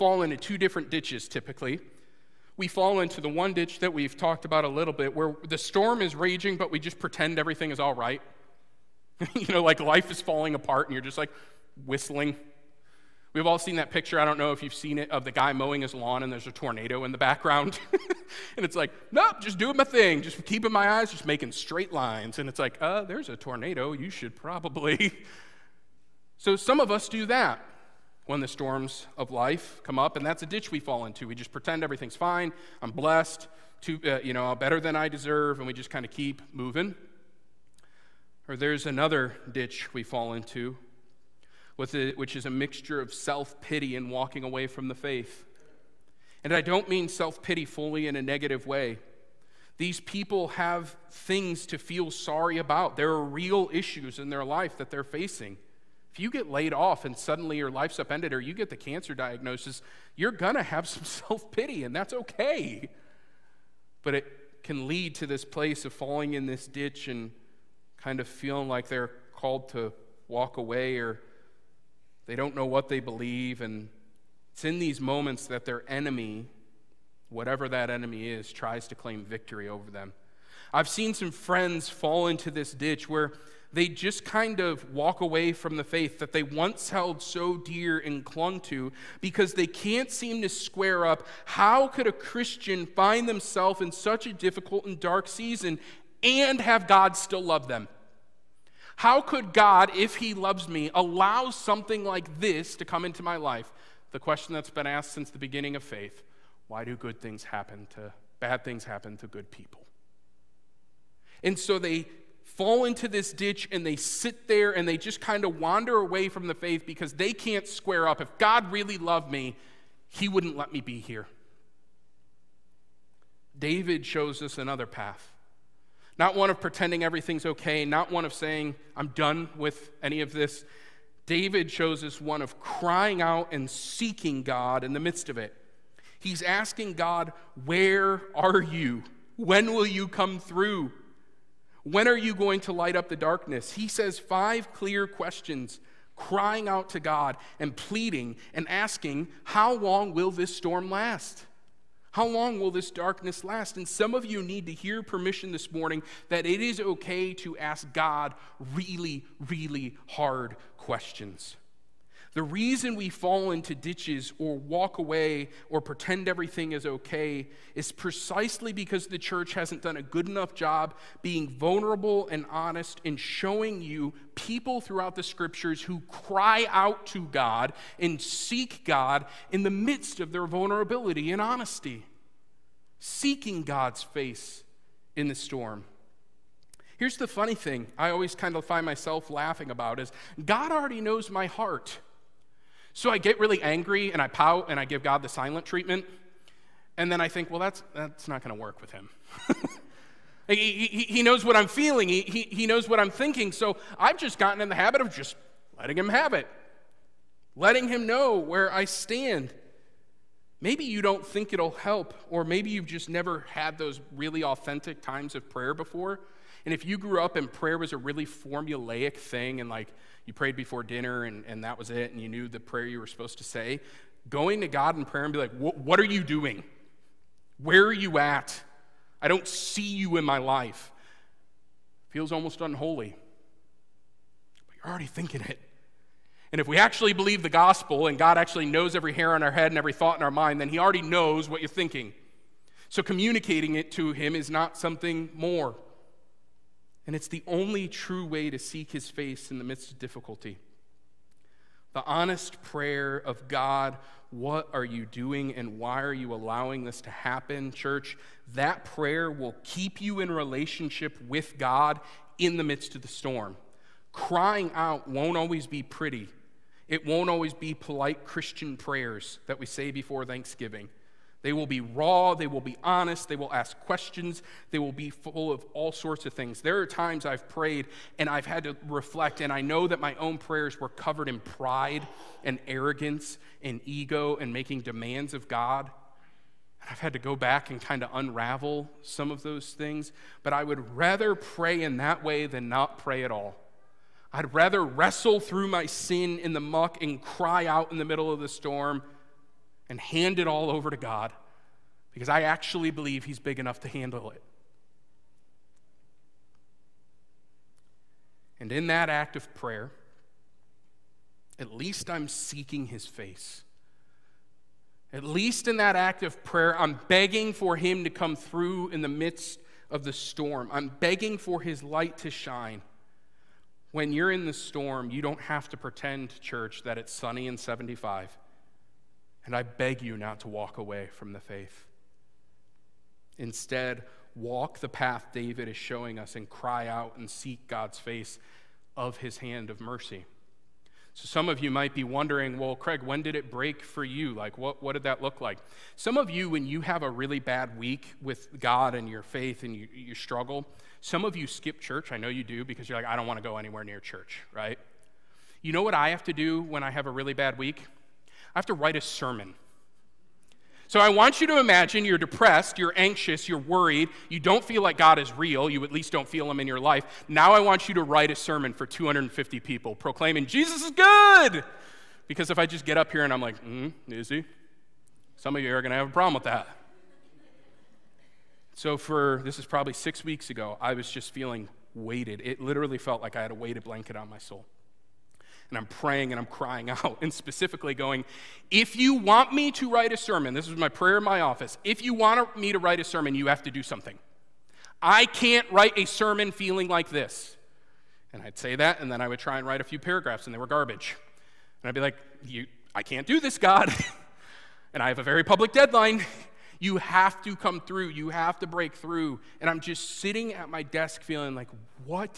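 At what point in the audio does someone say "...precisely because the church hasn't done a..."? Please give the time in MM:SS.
02:47.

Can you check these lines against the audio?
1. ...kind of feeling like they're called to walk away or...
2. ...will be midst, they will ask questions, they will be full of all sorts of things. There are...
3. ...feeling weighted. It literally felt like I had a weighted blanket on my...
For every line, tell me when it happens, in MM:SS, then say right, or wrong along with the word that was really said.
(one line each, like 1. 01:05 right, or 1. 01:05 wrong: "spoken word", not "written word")
1. 01:07 right
2. 04:32 wrong: "honest", not "midst"
3. 06:21 right.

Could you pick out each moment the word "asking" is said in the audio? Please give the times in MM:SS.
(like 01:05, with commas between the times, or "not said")
02:16, 02:28.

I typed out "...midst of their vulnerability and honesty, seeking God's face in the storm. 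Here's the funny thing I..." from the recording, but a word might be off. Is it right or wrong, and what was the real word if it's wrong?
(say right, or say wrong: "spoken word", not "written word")
right.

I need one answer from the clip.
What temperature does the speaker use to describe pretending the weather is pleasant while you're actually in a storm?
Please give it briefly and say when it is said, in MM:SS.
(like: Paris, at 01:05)
75, at 05:27.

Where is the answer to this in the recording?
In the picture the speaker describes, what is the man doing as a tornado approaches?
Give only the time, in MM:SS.
00:15.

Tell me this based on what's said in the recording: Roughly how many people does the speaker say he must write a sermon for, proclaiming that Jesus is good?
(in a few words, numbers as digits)
250.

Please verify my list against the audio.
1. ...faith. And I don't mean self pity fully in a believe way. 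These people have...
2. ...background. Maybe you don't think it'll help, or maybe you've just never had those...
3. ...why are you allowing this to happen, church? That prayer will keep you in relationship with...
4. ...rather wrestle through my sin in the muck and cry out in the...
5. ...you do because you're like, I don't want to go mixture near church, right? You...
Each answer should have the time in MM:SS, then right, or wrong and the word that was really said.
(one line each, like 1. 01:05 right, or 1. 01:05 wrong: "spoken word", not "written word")
1. 00:44 wrong: "negative", not "believe"
2. 03:28 wrong: "stand", not "background"
3. 04:15 right
4. 04:54 right
5. 05:52 wrong: "anywhere", not "mixture".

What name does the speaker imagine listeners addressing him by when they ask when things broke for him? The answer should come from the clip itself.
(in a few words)
Craig.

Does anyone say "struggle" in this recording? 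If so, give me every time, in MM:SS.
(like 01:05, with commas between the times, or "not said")
05:50.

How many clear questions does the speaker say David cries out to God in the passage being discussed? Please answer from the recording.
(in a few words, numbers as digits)
5.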